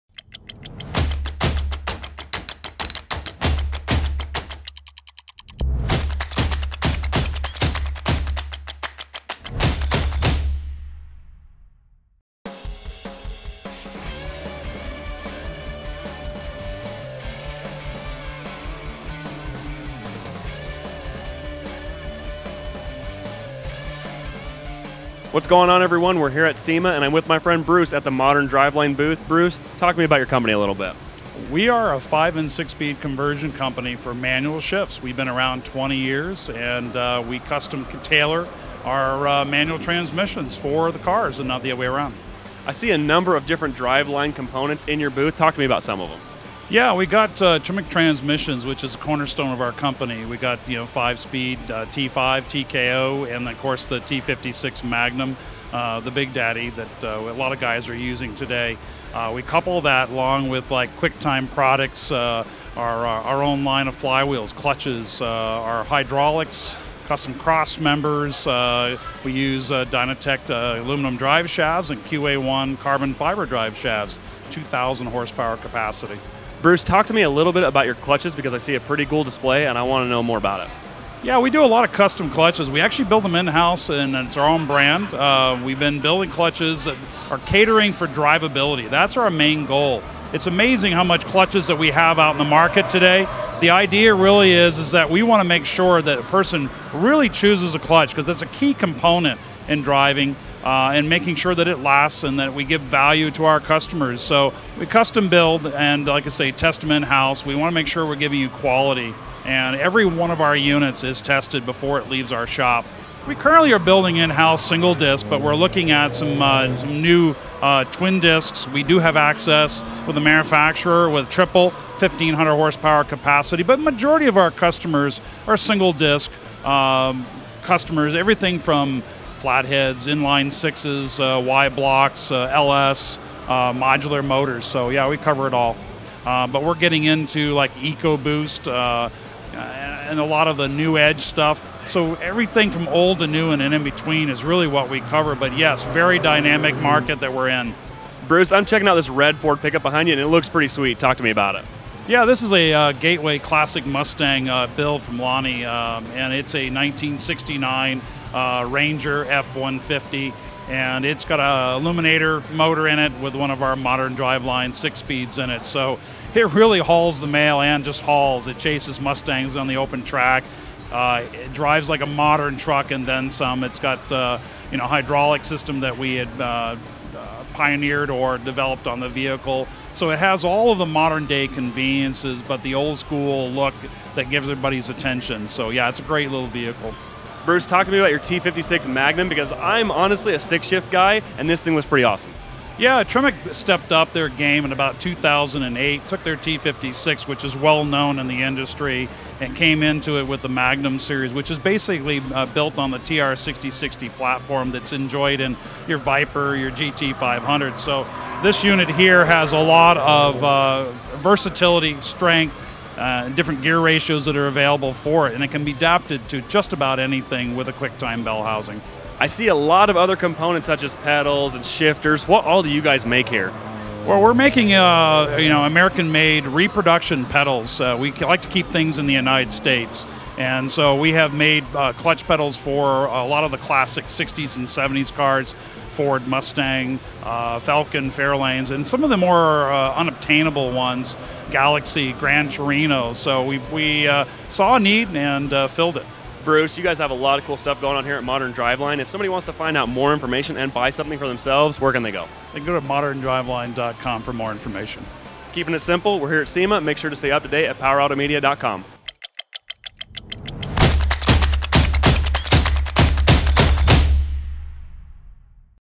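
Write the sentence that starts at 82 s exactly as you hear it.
We actually build them in house and it's our own brand.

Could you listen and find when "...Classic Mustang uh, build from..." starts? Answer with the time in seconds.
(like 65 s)
153 s.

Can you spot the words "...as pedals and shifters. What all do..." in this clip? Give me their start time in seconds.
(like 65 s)
220 s.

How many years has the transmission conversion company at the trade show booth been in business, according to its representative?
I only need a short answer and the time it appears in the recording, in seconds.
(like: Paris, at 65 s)
20 years, at 35 s.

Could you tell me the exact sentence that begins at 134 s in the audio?
So yeah, we cover it all.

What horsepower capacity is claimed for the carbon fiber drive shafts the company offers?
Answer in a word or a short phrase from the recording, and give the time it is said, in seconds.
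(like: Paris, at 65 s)
2,000 horsepower, at 74 s.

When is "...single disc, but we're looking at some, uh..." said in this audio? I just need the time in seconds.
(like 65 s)
114 s.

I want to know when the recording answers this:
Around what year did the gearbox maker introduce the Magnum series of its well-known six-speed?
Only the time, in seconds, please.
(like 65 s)
195 s.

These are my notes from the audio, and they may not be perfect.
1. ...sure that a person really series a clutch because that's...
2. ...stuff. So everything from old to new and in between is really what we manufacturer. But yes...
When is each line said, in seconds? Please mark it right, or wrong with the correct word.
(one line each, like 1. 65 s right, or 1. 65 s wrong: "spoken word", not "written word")
1. 95 s wrong: "chooses", not "series"
2. 141 s wrong: "cover", not "manufacturer".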